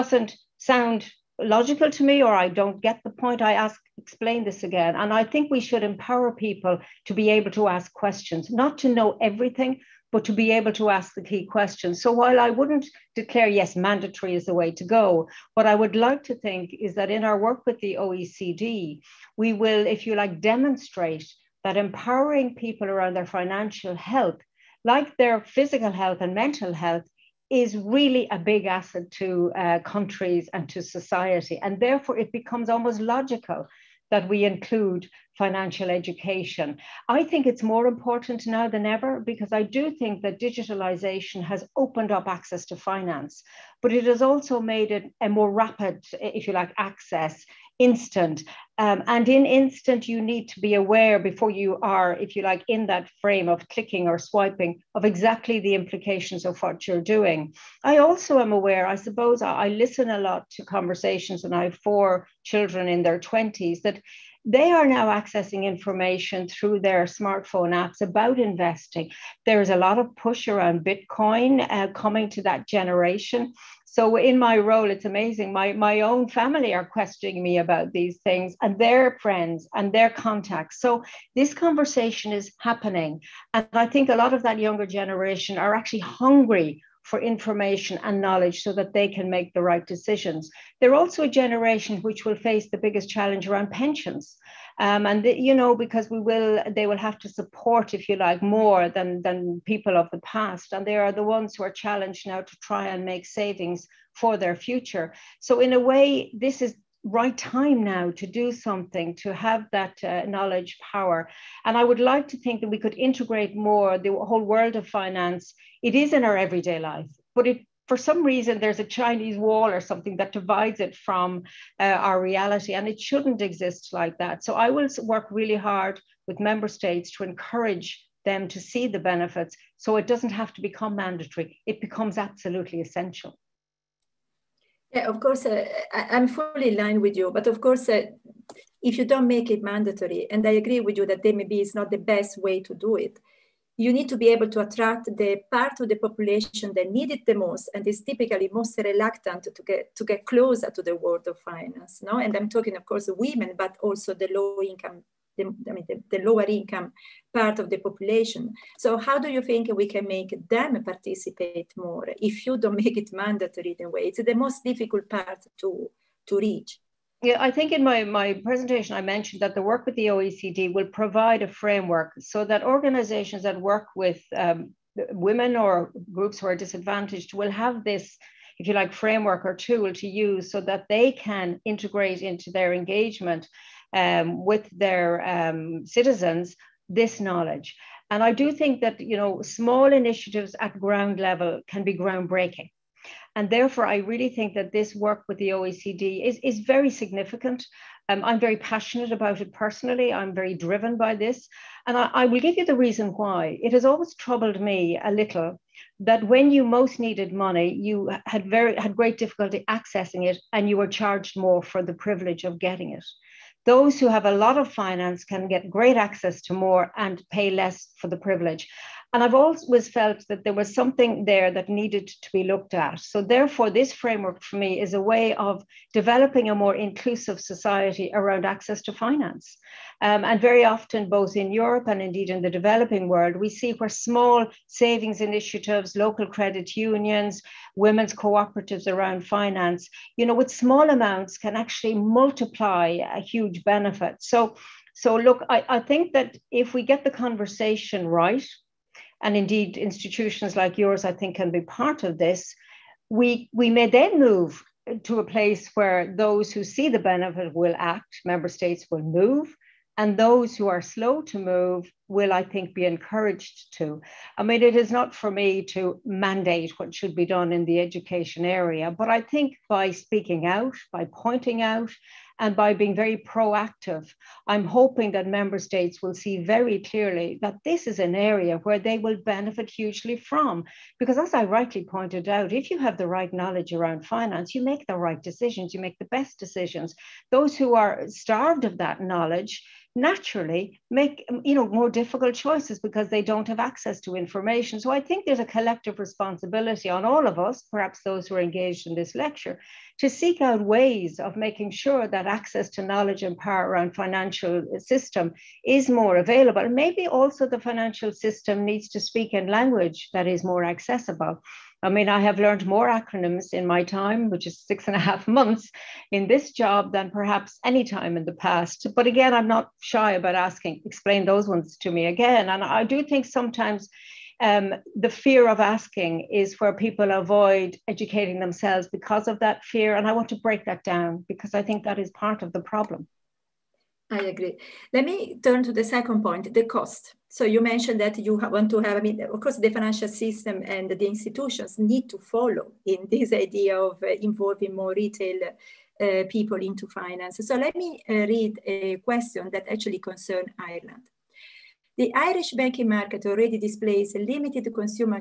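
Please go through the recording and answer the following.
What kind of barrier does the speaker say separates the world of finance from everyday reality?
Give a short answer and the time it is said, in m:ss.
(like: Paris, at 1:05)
Chinese wall, at 1:58.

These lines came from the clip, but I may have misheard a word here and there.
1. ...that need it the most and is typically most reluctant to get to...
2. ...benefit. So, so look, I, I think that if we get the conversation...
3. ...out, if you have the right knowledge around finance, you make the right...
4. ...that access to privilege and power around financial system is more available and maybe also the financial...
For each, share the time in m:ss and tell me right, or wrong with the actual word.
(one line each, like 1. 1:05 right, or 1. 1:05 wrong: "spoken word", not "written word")
1. 2:26 right
2. 4:03 right
3. 4:42 right
4. 5:02 wrong: "knowledge", not "privilege".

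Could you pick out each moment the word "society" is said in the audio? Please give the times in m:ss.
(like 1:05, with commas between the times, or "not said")
0:30, 3:47.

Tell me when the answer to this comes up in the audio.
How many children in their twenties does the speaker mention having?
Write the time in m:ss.
1:01.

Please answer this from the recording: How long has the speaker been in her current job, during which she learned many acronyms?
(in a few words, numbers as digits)
6.5 months.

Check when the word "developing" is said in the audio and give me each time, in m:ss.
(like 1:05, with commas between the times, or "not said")
3:45, 3:52.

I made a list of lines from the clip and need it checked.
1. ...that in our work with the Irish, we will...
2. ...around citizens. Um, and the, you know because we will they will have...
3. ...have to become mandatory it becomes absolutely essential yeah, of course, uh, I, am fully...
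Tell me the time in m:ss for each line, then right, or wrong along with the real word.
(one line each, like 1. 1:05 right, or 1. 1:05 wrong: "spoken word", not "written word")
1. 0:16 wrong: "OECD", not "Irish"
2. 1:33 wrong: "pensions", not "citizens"
3. 2:10 right.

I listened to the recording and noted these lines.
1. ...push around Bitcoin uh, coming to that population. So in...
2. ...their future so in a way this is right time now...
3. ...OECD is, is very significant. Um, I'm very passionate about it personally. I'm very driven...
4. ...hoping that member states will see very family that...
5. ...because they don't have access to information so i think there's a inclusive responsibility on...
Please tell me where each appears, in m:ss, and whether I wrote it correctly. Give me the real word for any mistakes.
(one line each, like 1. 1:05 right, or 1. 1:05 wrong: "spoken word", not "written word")
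1. 1:10 wrong: "generation", not "population"
2. 1:44 right
3. 3:15 right
4. 4:34 wrong: "clearly", not "family"
5. 4:52 wrong: "collective", not "inclusive".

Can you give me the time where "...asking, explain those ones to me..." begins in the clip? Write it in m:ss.
5:20.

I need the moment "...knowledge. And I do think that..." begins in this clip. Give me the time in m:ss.
3:07.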